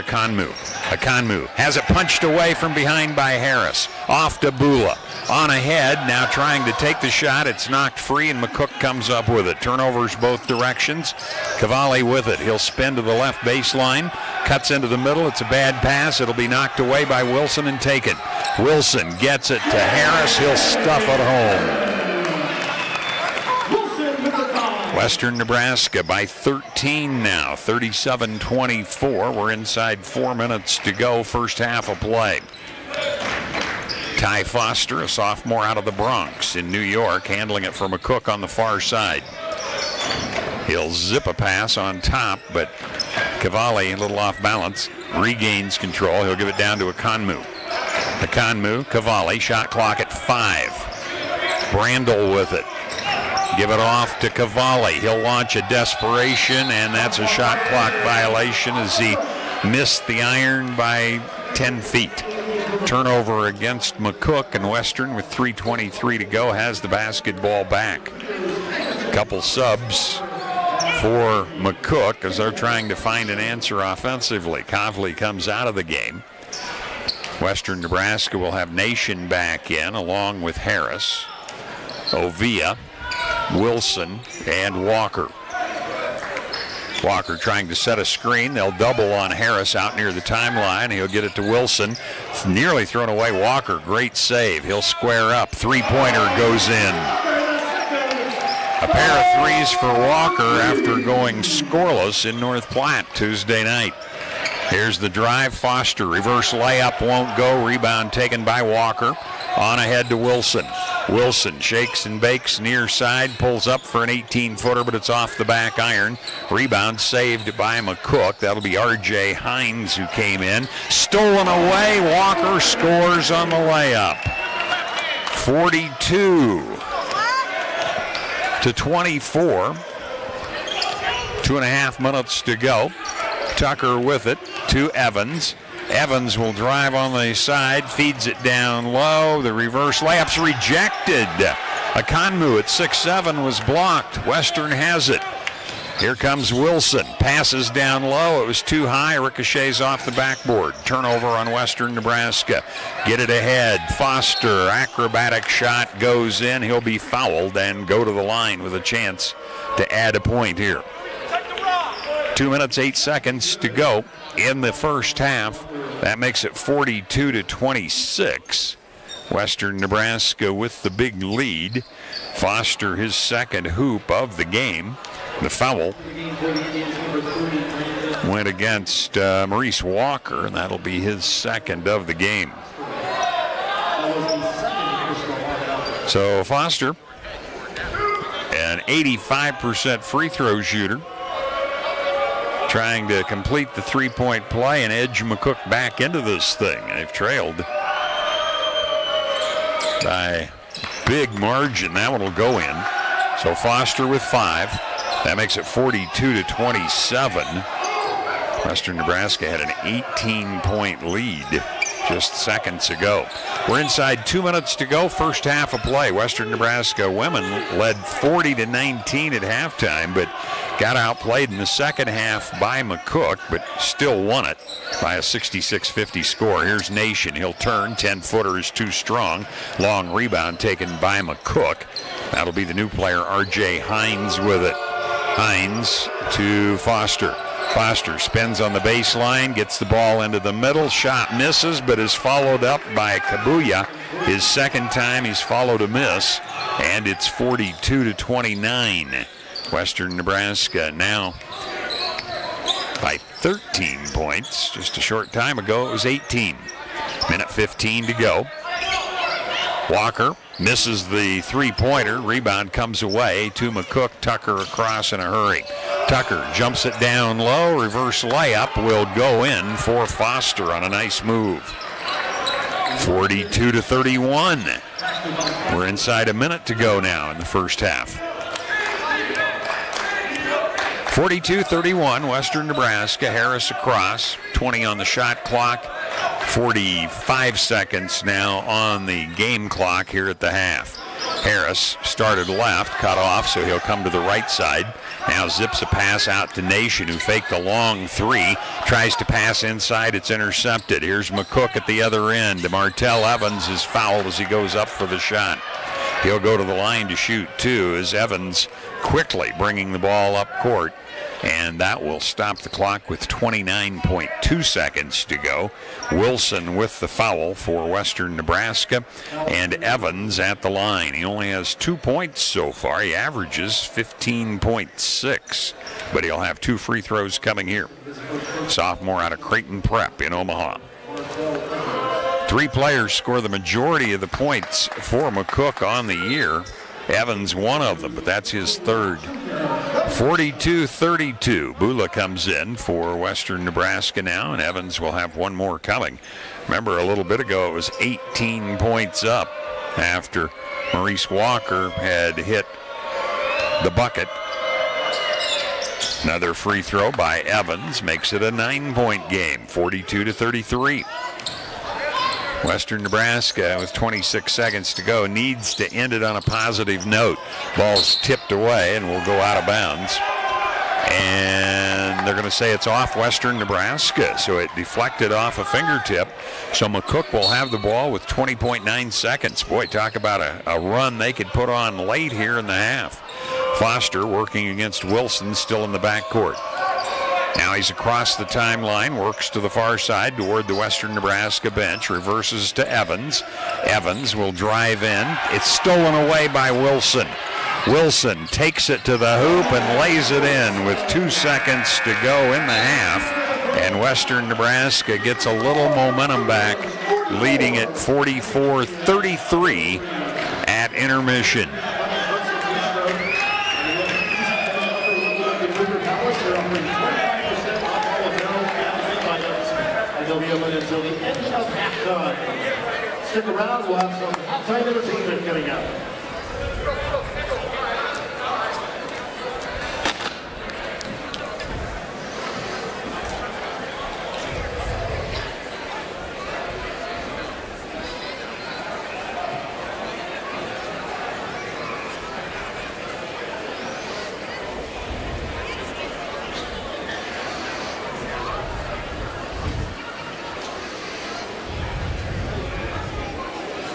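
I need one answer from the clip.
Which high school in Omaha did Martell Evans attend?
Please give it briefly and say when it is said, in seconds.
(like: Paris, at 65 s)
Creighton Prep, at 329 s.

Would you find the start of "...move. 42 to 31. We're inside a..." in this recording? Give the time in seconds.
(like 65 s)
271 s.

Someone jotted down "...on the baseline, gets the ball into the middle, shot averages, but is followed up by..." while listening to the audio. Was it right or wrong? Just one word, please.
wrong.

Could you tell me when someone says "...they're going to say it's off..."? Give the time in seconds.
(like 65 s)
372 s.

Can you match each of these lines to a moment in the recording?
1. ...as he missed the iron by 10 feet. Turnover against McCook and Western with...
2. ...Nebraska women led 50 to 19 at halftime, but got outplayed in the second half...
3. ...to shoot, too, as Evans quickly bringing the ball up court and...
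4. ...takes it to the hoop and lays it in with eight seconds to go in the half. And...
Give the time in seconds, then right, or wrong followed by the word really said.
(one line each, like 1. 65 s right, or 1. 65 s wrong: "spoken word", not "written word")
1. 58 s right
2. 216 s wrong: "40", not "50"
3. 307 s right
4. 398 s wrong: "two", not "eight".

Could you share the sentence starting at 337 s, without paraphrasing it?
Evans, one of them, but that's his third.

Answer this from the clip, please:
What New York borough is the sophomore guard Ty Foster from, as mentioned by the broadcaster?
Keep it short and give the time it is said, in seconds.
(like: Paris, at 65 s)
Bronx, at 35 s.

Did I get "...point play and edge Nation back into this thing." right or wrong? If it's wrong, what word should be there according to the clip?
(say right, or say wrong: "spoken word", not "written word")
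wrong: "McCook", not "Nation".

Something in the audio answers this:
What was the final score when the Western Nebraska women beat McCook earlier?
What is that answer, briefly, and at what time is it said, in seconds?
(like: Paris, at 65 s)
66-50, at 225 s.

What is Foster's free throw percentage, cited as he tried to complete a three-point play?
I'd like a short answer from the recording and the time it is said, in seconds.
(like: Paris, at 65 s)
85%, at 188 s.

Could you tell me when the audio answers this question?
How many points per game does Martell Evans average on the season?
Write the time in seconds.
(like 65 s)
323 s.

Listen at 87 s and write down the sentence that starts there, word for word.
Walker trying to set a screen.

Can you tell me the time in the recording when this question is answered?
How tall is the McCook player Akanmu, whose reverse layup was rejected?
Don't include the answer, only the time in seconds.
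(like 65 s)
142 s.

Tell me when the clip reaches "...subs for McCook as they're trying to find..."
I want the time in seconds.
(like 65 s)
69 s.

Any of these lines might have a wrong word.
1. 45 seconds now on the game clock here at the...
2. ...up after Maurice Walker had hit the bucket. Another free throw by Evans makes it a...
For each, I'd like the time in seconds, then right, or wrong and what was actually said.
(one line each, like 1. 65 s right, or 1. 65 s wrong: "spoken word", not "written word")
1. 286 s right
2. 349 s right.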